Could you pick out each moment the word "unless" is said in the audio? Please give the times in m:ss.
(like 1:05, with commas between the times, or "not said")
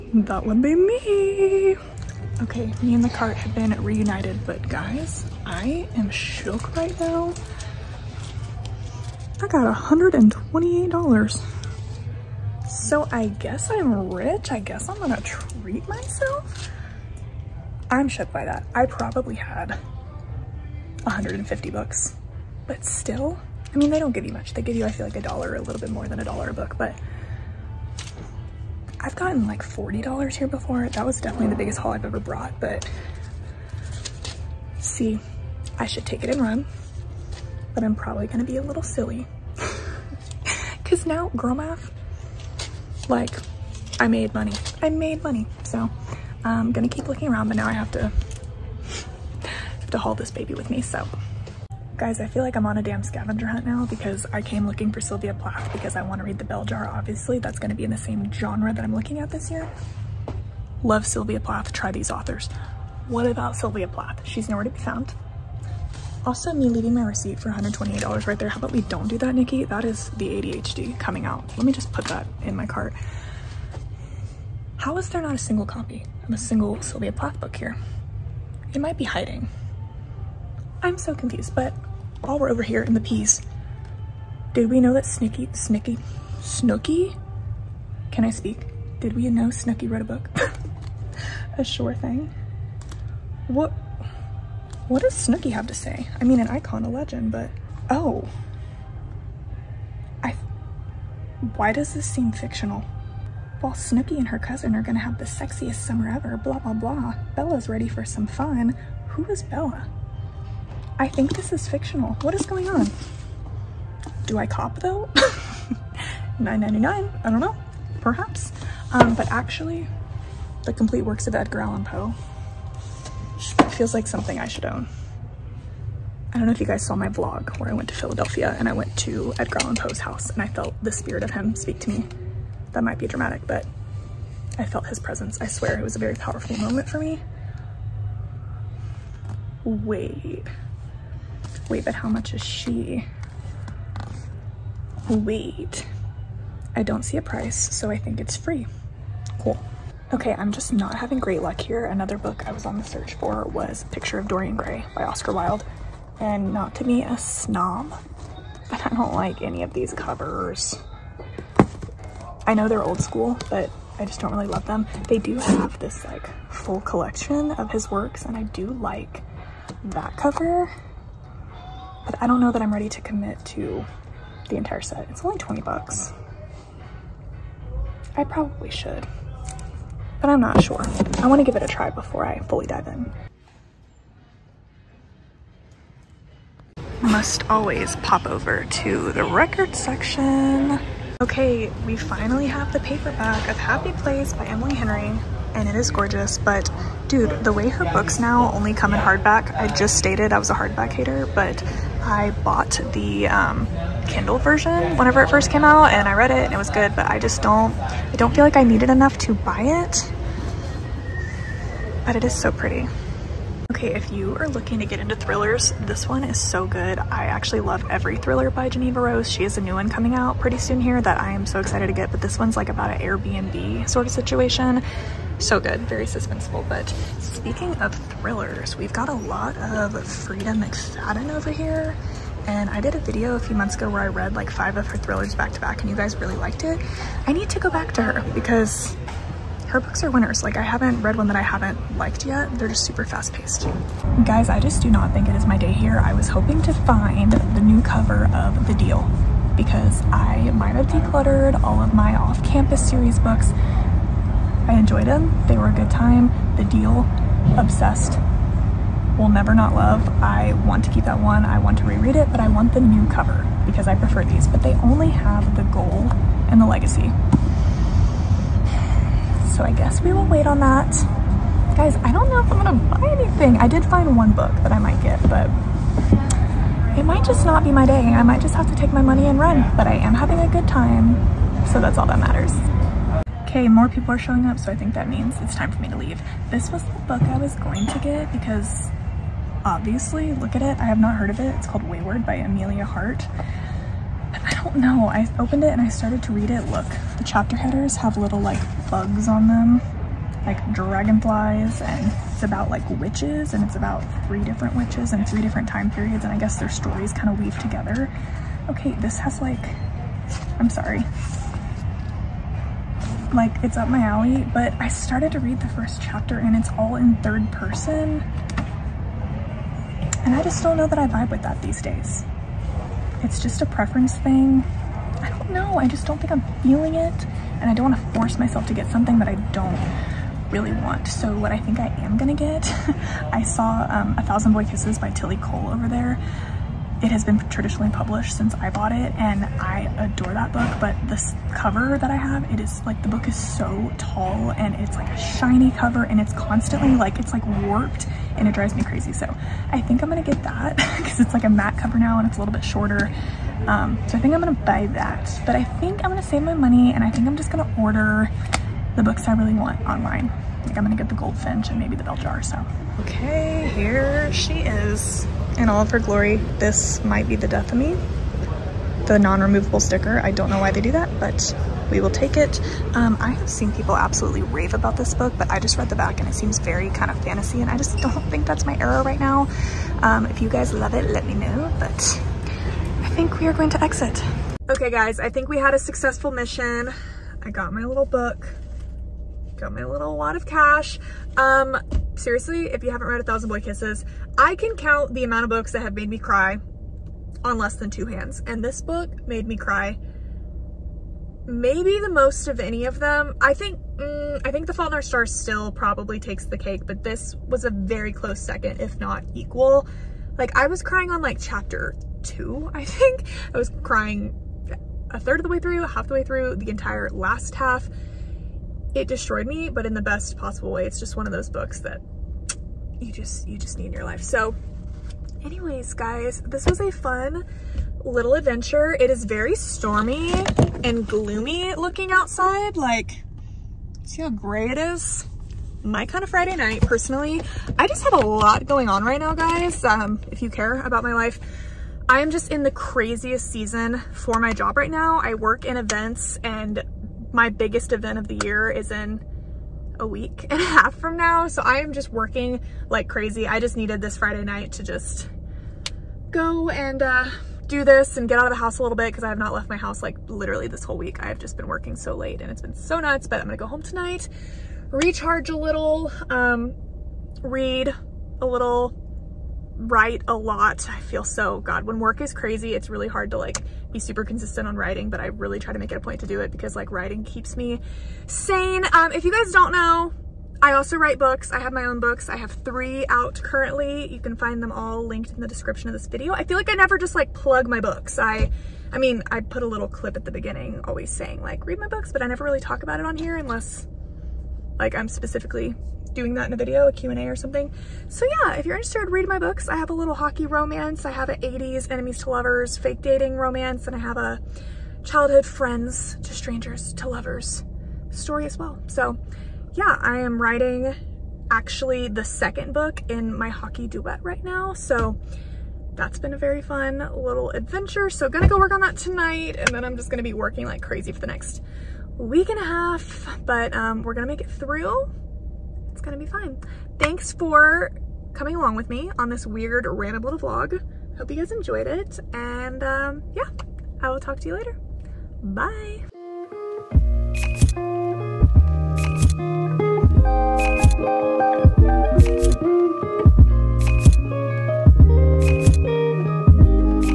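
8:13.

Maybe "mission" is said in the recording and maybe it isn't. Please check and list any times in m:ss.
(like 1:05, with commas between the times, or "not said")
6:26.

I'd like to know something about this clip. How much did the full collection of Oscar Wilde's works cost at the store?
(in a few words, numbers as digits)
20 bucks.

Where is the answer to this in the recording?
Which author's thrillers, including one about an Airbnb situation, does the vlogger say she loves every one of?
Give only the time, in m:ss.
3:38.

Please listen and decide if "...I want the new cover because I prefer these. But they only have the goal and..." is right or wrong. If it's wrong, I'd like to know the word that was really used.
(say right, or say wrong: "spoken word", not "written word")
right.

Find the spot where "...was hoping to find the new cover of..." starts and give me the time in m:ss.
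4:06.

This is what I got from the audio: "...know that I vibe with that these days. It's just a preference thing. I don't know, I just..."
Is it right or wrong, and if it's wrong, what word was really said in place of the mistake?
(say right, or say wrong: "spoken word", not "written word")
right.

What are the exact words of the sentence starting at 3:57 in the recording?
I need to go back to her because her books are winners.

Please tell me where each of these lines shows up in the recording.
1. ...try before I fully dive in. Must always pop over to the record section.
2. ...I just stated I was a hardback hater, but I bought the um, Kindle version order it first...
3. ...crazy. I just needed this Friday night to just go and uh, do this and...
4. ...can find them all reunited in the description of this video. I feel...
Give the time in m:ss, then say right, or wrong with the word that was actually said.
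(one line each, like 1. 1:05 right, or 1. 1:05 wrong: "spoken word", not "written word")
1. 3:01 right
2. 3:19 wrong: "whenever", not "order"
3. 7:33 right
4. 8:04 wrong: "linked", not "reunited".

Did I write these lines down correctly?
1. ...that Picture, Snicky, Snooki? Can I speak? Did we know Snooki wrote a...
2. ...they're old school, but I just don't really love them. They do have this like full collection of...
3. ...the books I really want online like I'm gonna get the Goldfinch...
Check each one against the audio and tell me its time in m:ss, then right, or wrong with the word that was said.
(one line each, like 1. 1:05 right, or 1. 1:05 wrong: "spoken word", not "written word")
1. 1:24 wrong: "Snicky", not "Picture"
2. 2:42 right
3. 5:58 right.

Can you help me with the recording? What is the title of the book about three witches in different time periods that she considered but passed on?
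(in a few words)
Weyward.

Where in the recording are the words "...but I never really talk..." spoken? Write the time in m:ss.
8:12.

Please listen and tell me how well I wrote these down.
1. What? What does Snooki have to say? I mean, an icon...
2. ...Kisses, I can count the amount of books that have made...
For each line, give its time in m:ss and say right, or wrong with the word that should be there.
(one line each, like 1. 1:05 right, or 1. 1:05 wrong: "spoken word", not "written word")
1. 1:33 right
2. 6:33 right.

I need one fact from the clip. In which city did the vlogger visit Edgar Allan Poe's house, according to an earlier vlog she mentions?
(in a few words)
Philadelphia.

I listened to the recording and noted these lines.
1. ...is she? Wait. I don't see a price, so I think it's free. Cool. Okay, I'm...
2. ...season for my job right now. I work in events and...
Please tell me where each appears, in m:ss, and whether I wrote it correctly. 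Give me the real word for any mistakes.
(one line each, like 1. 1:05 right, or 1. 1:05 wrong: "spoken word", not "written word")
1. 2:22 right
2. 7:23 right.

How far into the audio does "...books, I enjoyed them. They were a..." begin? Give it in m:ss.
4:13.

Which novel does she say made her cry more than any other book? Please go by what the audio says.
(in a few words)
The Fault in Our Stars.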